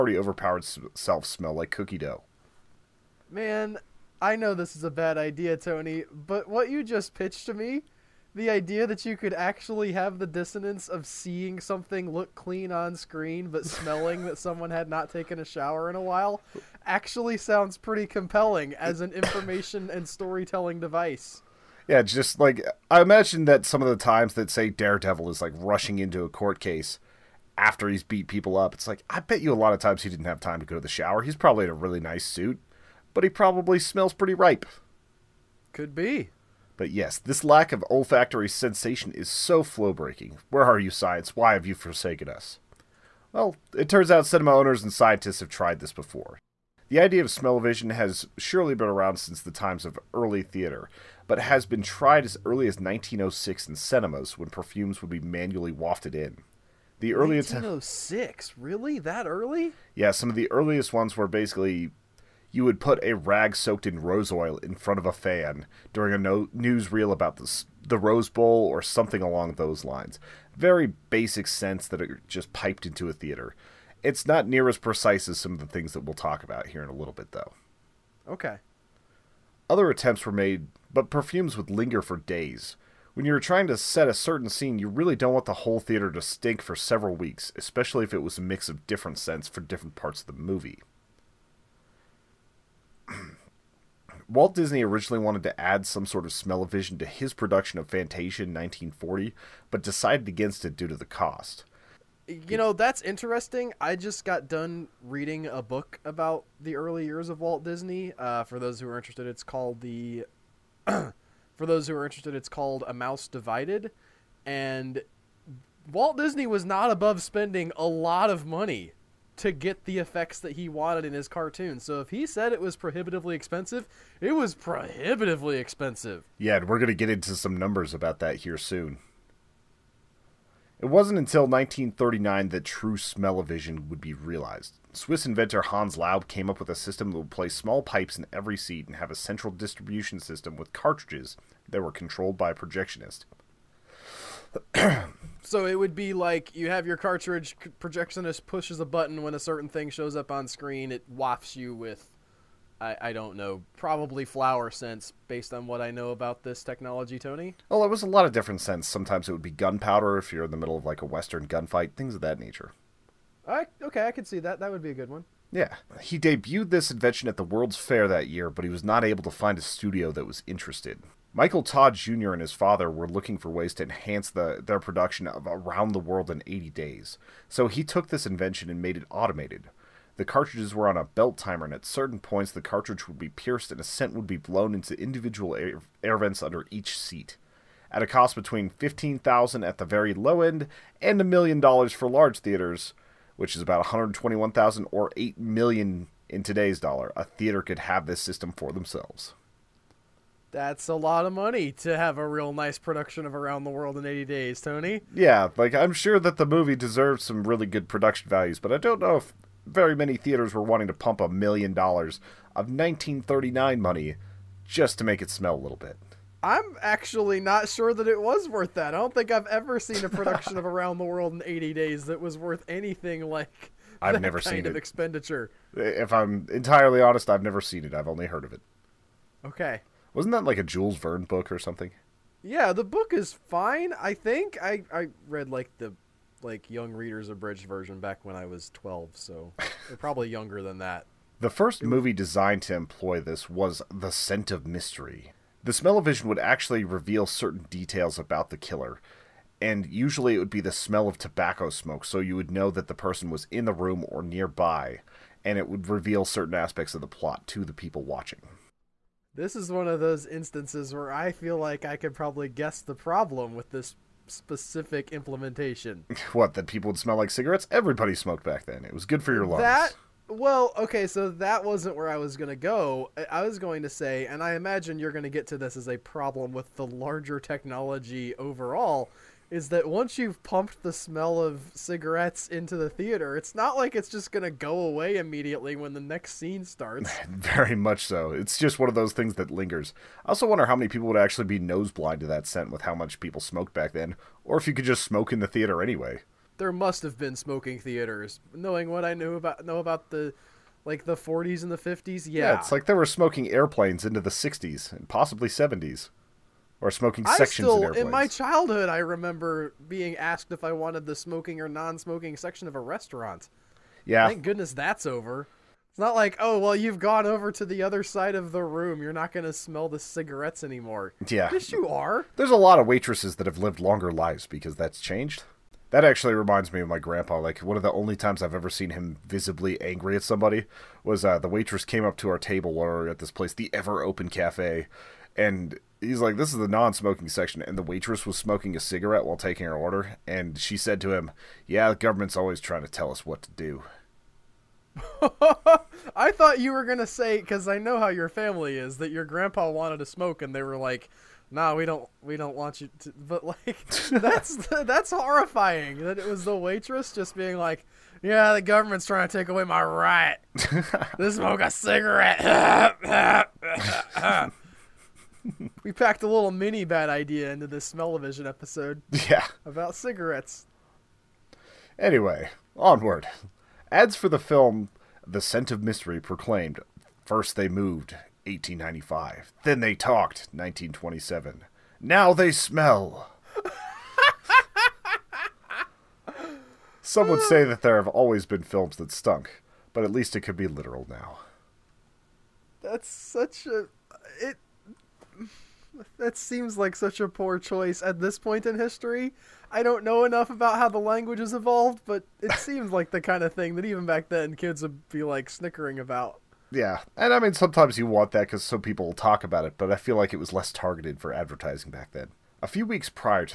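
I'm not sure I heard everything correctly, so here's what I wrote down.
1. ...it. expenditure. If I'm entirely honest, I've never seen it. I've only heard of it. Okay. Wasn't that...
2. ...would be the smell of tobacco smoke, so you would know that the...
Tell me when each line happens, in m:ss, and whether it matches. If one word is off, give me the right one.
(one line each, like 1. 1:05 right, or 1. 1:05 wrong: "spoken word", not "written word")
1. 3:44 right
2. 4:10 right.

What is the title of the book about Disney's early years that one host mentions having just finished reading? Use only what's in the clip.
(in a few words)
A Mouse Divided.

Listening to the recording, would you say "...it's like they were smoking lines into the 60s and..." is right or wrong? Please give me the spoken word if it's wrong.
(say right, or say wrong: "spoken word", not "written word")
wrong: "airplanes", not "lines".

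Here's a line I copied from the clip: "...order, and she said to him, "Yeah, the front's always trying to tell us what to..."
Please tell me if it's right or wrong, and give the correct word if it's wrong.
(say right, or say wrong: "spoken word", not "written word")
wrong: "government", not "front".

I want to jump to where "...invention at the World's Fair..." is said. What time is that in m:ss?
2:46.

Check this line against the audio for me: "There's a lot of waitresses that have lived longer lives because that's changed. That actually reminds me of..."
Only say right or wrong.
right.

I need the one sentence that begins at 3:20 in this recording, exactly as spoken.
That's a lot of money to have a real nice production of Around the World in 80 Days, Tony.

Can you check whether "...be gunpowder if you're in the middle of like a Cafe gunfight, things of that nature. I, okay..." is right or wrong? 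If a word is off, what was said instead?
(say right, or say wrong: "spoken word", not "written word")
wrong: "Western", not "Cafe".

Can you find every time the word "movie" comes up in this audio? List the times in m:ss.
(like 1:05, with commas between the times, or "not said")
1:30, 3:26, 4:01.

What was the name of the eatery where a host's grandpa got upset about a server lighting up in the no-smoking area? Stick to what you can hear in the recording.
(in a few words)
Ever Open Cafe.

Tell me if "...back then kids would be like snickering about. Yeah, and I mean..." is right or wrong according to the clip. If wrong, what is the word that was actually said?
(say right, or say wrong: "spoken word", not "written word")
right.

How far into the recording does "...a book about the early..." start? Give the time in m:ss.
1:45.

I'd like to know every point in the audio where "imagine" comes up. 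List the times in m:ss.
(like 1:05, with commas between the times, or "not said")
0:23, 4:34.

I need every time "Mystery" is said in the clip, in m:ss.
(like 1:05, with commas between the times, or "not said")
4:04, 6:15.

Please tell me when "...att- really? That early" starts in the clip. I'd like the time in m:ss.
0:58.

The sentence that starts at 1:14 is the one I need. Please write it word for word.
It's not near as precise as some of the things that we'll talk about here in a little bit, though.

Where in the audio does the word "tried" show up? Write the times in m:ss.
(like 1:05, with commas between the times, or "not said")
0:45, 0:51.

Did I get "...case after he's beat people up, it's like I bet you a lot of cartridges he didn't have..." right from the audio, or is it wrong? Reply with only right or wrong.
wrong.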